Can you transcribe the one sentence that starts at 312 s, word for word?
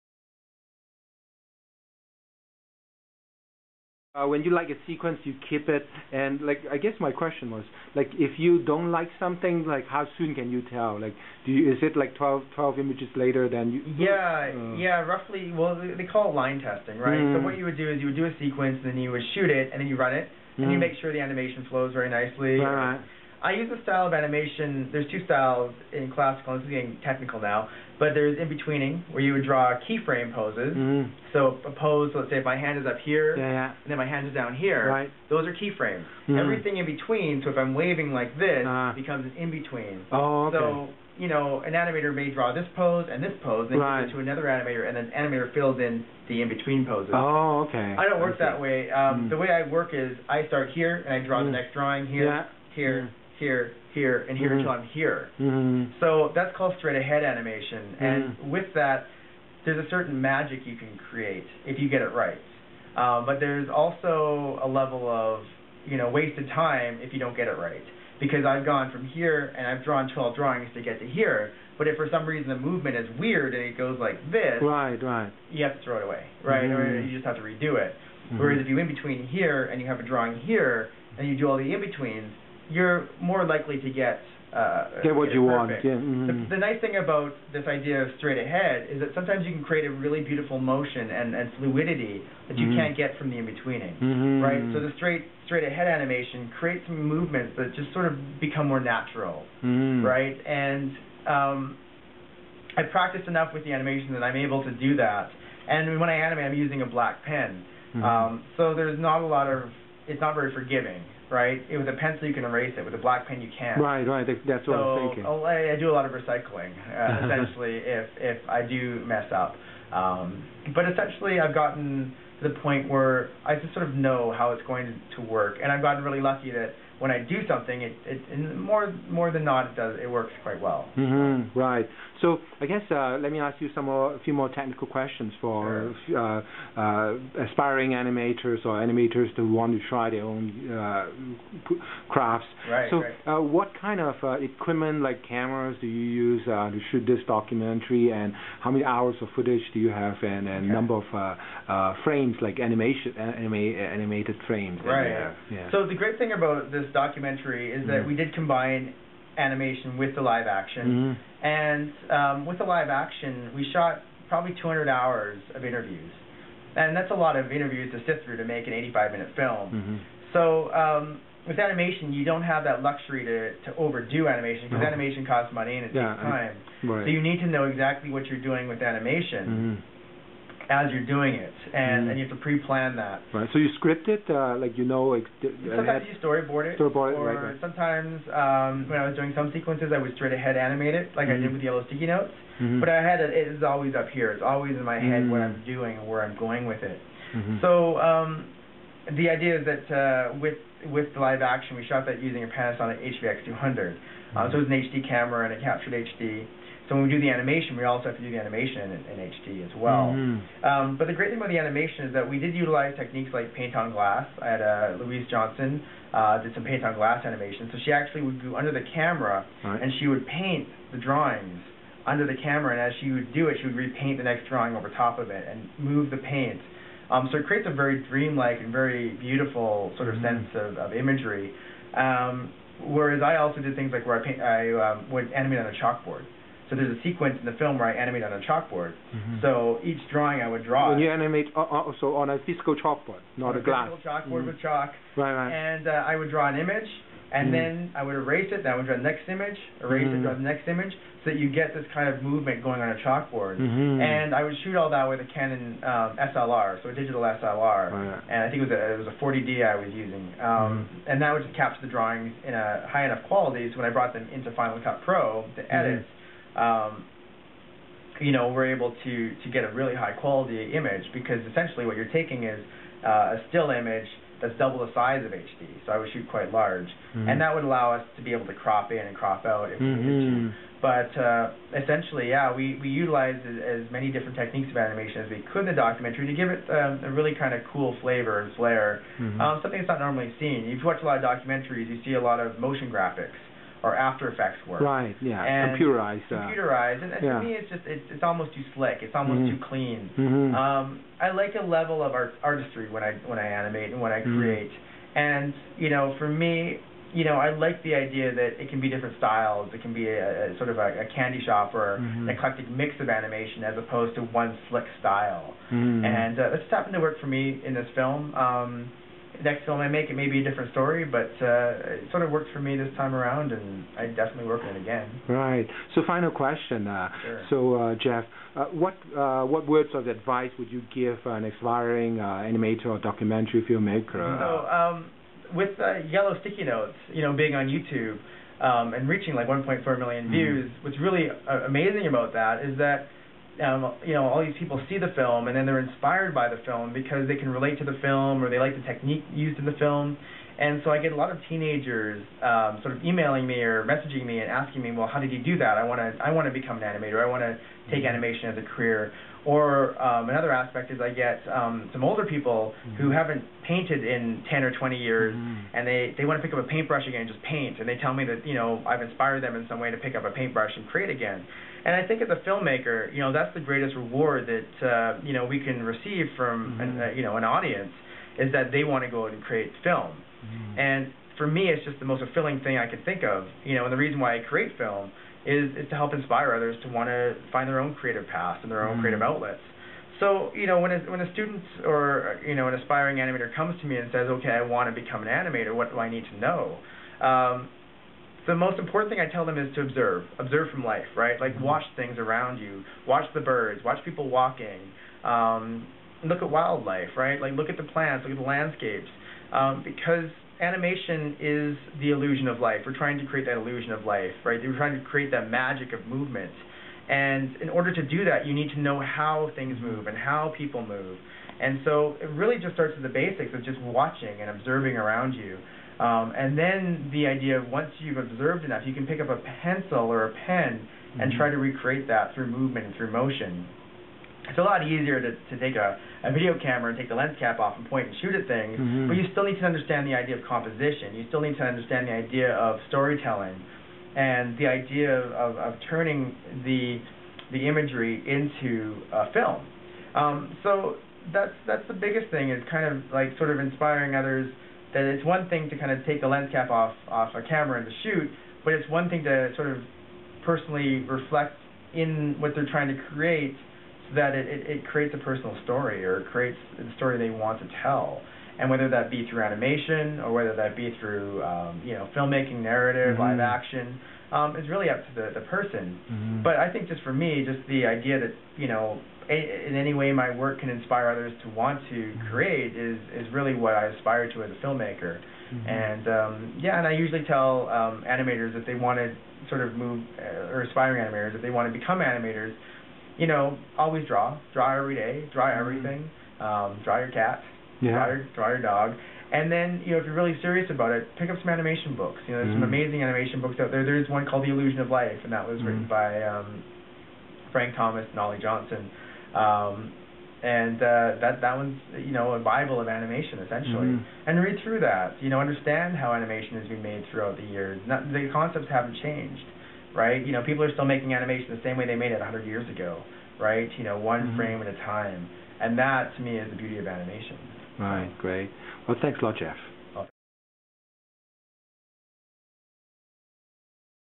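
an eclectic mix of animation as opposed to one slick style.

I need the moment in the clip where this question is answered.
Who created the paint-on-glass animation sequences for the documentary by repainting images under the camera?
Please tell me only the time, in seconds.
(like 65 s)
214 s.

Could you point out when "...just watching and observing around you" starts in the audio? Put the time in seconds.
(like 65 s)
423 s.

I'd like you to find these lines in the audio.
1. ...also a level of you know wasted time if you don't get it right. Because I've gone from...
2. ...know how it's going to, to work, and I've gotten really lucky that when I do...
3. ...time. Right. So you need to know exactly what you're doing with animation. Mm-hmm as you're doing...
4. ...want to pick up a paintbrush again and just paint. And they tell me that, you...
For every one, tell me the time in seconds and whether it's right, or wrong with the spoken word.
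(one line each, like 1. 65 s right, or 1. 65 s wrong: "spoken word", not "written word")
1. 63 s right
2. 123 s right
3. 176 s right
4. 366 s right.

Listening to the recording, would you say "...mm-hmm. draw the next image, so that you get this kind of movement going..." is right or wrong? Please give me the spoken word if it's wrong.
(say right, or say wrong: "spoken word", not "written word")
right.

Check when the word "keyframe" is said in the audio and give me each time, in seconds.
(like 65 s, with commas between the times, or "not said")
29 s, 35 s.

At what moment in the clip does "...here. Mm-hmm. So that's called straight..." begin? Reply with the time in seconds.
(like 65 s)
54 s.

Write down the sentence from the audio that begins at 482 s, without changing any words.
create is is really what I aspire to as a filmmaker.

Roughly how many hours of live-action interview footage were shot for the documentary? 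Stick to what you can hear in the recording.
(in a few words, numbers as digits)
200.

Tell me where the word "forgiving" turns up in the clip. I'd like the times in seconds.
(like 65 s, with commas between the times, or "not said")
110 s.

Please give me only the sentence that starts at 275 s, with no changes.
So I would shoot quite large, mm-hmm.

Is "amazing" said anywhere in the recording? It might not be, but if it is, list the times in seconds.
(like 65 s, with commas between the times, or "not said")
341 s, 502 s.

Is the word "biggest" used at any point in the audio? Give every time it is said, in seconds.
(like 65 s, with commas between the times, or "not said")
451 s.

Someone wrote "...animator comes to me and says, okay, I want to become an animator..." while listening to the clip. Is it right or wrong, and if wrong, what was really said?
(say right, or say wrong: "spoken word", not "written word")
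right.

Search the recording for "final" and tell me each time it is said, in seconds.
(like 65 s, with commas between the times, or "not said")
264 s, 326 s.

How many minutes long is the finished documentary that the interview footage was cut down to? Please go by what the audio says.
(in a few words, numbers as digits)
85 minutes.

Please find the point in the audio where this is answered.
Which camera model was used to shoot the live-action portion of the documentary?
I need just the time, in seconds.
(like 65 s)
202 s.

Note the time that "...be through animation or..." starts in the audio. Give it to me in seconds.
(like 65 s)
469 s.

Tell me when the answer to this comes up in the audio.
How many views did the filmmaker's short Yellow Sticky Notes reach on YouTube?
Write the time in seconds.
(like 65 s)
339 s.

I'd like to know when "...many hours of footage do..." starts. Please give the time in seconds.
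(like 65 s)
148 s.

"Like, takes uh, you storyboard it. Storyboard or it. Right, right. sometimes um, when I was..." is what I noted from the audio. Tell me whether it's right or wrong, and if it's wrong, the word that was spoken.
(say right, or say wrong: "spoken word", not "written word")
wrong: "sometimes", not "takes".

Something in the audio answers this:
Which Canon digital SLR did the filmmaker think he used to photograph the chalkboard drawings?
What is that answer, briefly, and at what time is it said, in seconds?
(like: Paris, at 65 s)
40D, at 259 s.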